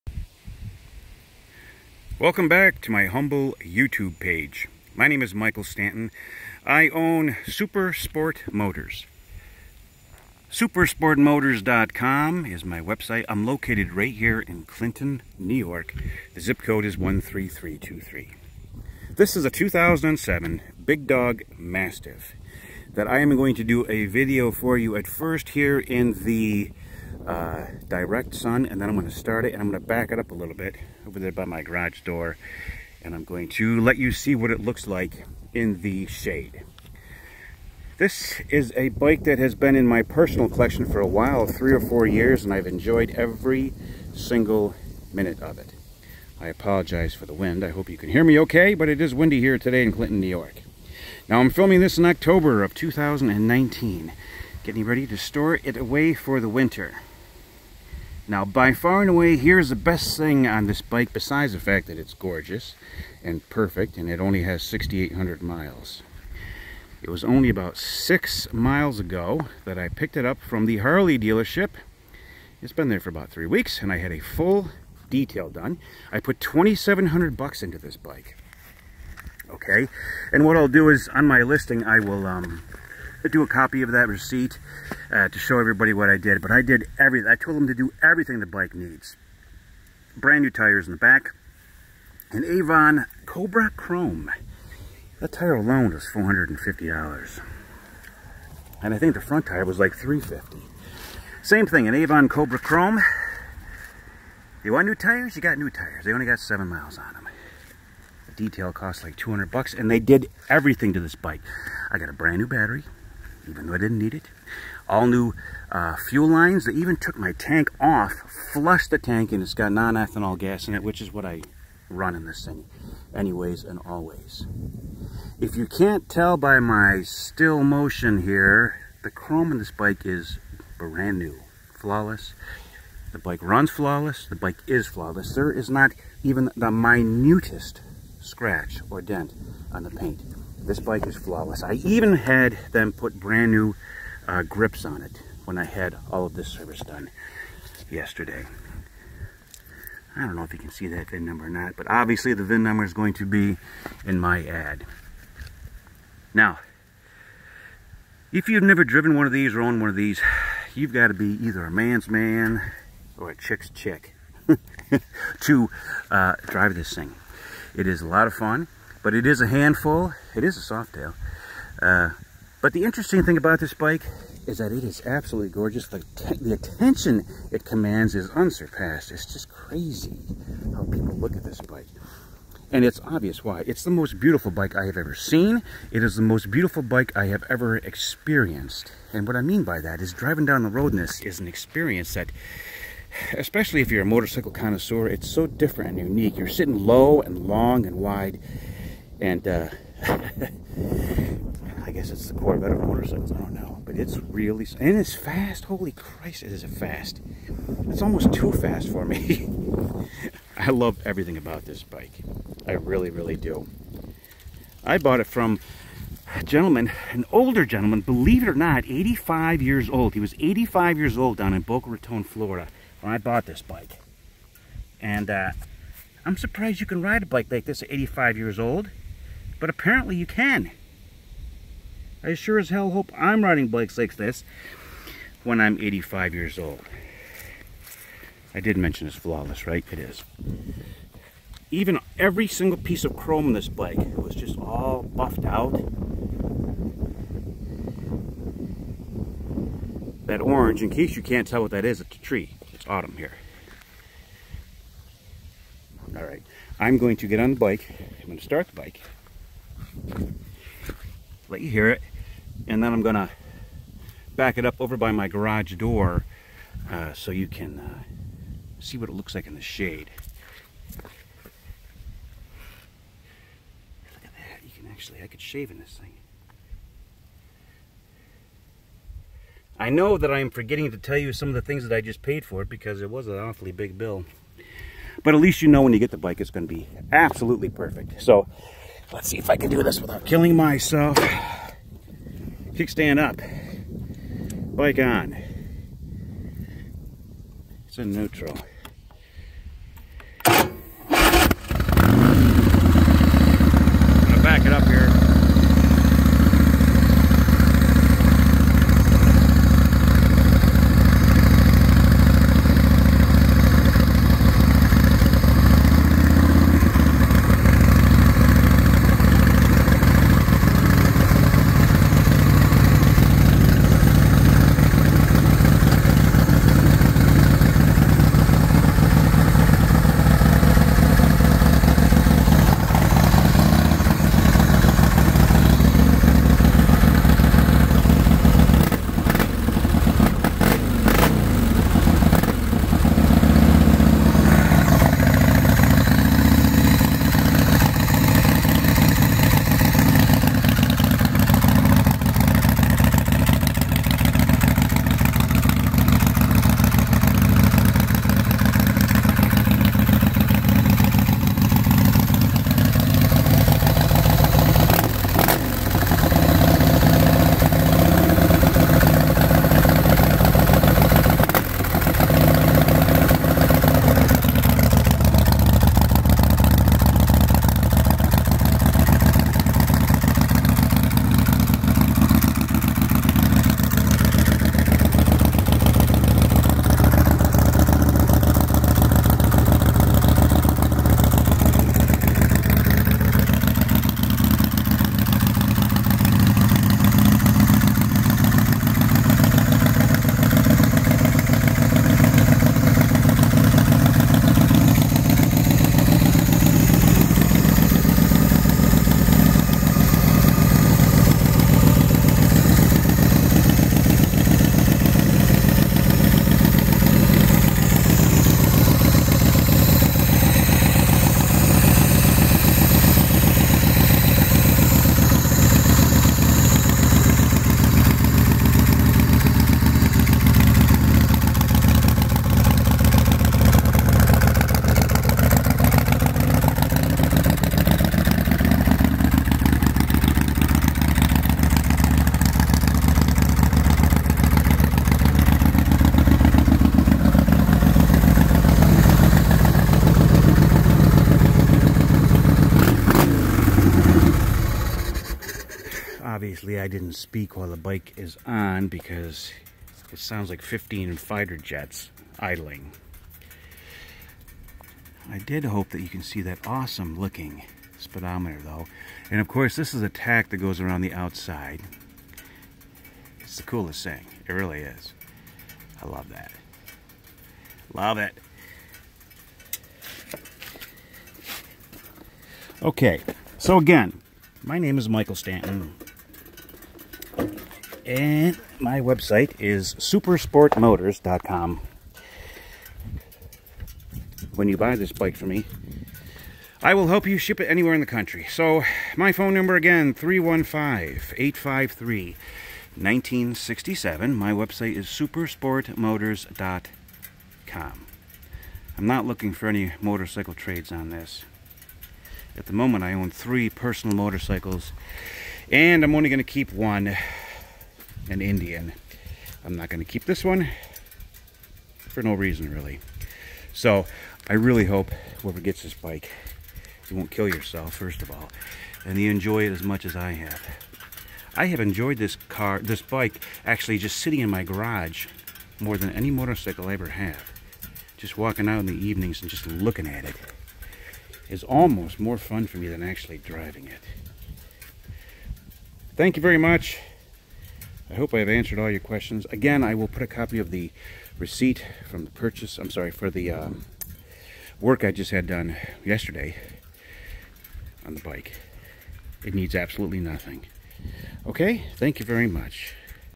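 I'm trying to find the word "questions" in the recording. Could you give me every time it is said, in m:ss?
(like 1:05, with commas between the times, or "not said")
9:08.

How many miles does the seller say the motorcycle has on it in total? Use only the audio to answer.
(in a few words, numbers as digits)
6,800.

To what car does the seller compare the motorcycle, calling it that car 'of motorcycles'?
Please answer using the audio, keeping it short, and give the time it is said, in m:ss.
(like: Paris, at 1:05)
Corvette, at 3:22.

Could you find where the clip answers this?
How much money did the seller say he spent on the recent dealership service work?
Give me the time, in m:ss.
1:16.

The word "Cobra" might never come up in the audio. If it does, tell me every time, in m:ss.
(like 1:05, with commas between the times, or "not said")
1:33, 1:42.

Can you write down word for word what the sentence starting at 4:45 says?
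But at least you know when you get the bike it's going to be absolutely perfect.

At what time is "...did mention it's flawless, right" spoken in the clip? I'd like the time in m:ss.
3:58.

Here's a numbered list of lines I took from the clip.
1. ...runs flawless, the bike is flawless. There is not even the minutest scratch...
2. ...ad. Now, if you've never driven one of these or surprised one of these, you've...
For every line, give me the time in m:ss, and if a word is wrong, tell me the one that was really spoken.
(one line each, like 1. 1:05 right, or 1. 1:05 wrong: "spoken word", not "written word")
1. 2:13 right
2. 2:34 wrong: "owned", not "surprised".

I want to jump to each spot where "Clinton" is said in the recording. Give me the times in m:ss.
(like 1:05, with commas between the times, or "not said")
0:14, 0:49.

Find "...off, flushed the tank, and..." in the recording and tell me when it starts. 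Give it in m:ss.
1:57.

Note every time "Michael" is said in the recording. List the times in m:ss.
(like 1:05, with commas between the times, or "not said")
0:05, 8:05.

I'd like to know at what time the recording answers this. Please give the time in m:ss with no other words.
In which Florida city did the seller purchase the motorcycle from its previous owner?
3:41.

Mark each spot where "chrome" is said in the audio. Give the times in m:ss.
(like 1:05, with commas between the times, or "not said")
1:33, 1:42, 2:09, 4:03.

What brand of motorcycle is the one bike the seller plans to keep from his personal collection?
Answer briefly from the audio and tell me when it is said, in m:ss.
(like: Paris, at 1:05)
Indian, at 8:38.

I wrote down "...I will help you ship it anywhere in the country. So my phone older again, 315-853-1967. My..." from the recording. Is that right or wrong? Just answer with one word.
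wrong.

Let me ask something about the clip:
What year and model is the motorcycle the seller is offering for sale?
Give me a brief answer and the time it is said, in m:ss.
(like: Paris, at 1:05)
2007 Big Dog Mastiff, at 0:19.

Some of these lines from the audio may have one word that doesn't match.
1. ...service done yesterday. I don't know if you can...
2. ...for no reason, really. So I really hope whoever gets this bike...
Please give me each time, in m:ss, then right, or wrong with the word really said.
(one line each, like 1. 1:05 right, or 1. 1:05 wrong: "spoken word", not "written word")
1. 2:26 right
2. 8:41 right.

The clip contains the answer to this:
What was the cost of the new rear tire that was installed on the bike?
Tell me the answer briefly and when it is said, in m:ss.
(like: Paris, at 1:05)
$450, at 1:36.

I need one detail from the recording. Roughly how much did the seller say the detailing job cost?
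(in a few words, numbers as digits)
$200.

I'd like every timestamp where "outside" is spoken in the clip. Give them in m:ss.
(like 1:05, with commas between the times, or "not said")
7:51.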